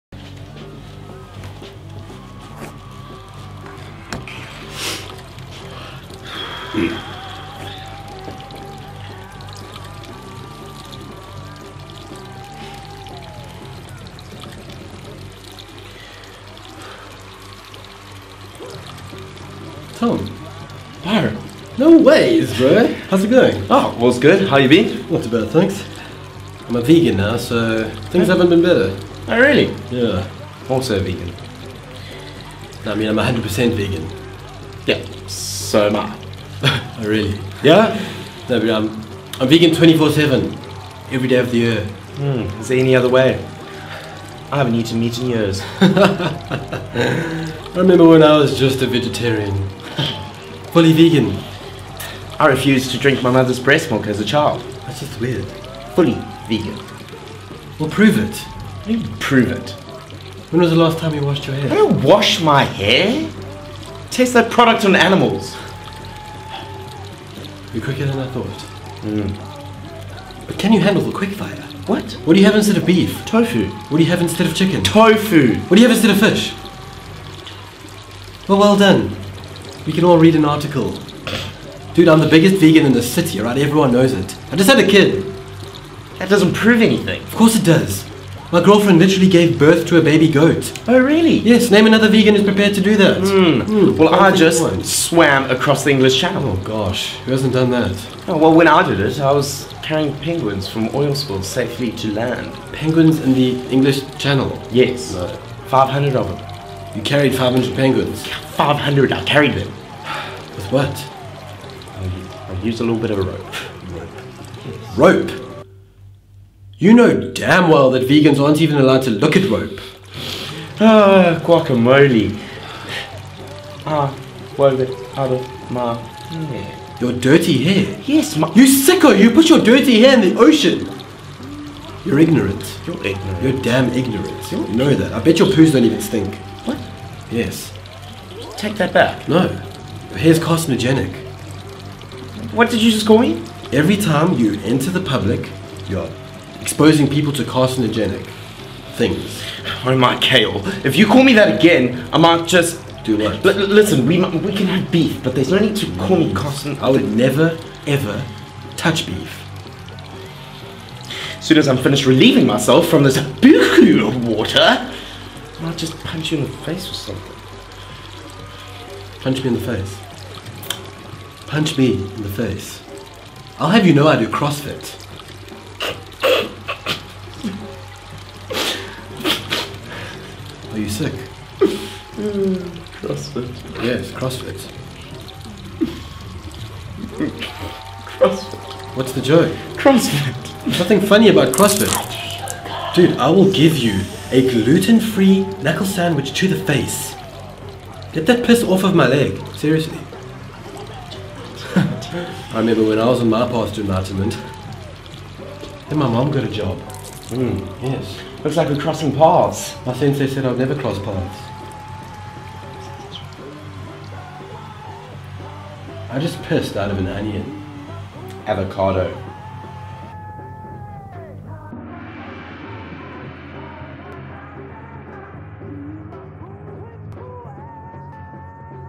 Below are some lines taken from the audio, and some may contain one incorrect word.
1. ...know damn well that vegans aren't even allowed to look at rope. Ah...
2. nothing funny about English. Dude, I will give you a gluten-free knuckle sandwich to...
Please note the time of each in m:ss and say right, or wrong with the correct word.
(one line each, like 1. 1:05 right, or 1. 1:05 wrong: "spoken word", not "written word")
1. 1:56 right
2. 3:10 wrong: "CrossFit", not "English".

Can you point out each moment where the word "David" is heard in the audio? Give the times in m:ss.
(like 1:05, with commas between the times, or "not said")
not said.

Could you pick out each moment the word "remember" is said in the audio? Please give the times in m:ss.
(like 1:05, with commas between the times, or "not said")
0:47, 3:22.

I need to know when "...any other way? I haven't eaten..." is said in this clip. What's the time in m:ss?
0:42.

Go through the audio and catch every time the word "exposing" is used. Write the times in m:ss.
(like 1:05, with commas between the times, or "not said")
2:26.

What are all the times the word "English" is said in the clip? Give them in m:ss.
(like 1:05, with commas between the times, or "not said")
1:35, 1:43.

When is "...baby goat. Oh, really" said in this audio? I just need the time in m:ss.
1:30.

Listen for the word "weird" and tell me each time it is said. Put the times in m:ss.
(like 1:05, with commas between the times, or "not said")
0:55.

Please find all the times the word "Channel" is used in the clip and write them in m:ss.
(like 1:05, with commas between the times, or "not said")
1:36, 1:44.